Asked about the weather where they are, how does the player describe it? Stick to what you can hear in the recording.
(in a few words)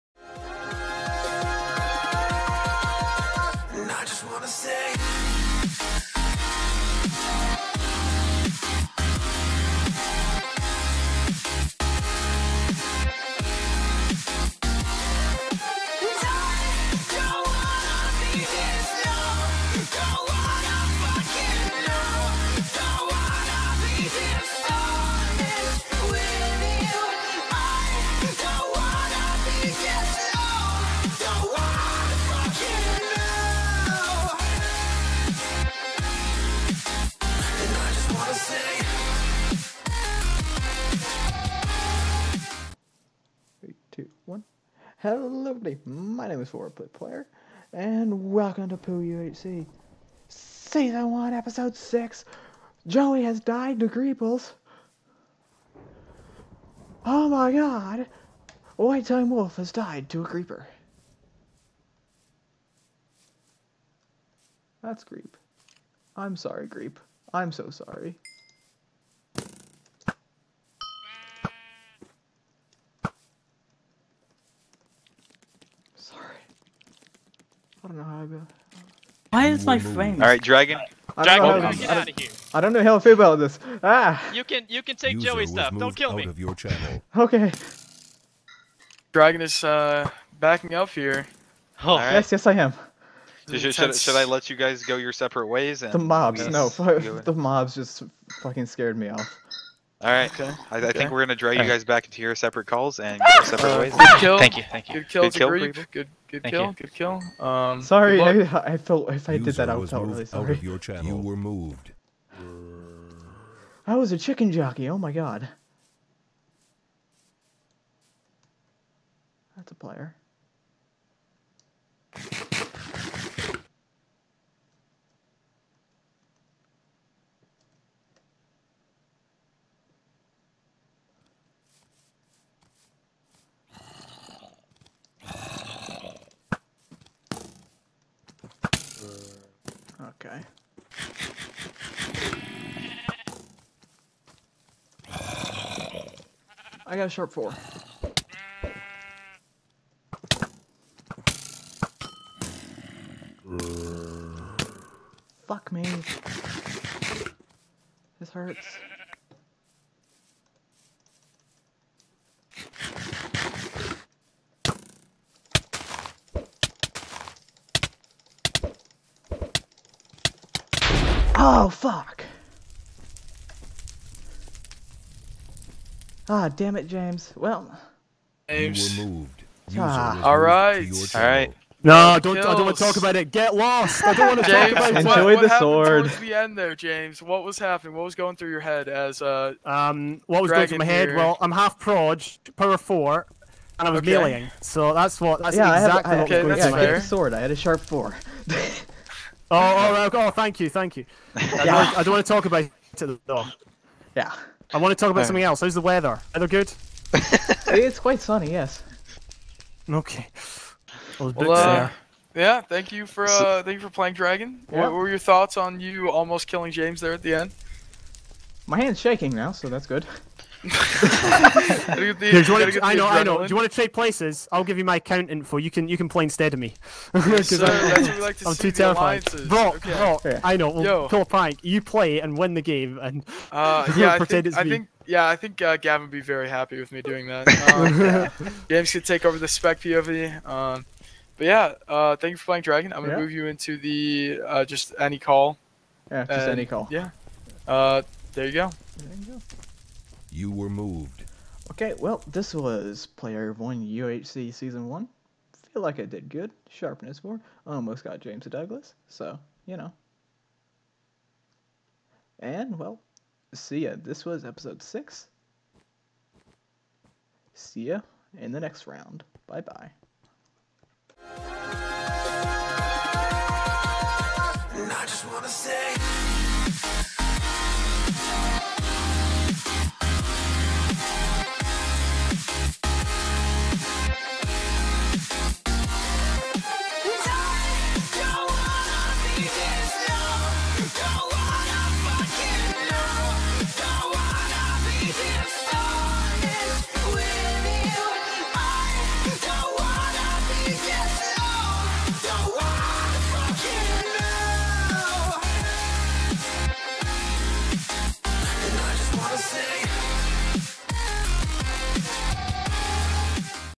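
Quite sunny.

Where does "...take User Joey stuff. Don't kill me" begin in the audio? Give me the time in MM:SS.
01:24.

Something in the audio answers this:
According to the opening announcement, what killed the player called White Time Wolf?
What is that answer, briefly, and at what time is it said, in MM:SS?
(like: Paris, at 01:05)
A Creeper, at 01:00.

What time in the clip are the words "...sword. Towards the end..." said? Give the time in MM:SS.
03:05.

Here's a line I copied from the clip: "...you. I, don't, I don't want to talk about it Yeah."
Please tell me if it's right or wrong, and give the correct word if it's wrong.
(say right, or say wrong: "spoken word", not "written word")
right.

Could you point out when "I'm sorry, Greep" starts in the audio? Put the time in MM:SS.
01:06.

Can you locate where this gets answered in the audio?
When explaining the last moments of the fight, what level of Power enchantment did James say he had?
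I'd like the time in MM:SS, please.
03:12.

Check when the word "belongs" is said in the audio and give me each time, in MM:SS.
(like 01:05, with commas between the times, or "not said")
not said.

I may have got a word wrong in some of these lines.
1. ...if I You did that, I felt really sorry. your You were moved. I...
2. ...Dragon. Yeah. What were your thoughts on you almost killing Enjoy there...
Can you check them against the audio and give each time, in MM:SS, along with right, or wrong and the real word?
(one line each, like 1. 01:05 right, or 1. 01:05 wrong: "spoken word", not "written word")
1. 01:49 wrong: "User", not "You"
2. 03:34 wrong: "James", not "Enjoy".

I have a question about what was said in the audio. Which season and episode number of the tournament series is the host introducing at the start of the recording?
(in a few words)
Season 1, Episode 6.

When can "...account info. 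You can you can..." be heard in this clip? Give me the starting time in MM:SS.
03:44.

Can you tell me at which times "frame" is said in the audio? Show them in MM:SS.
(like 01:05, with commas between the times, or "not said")
01:19.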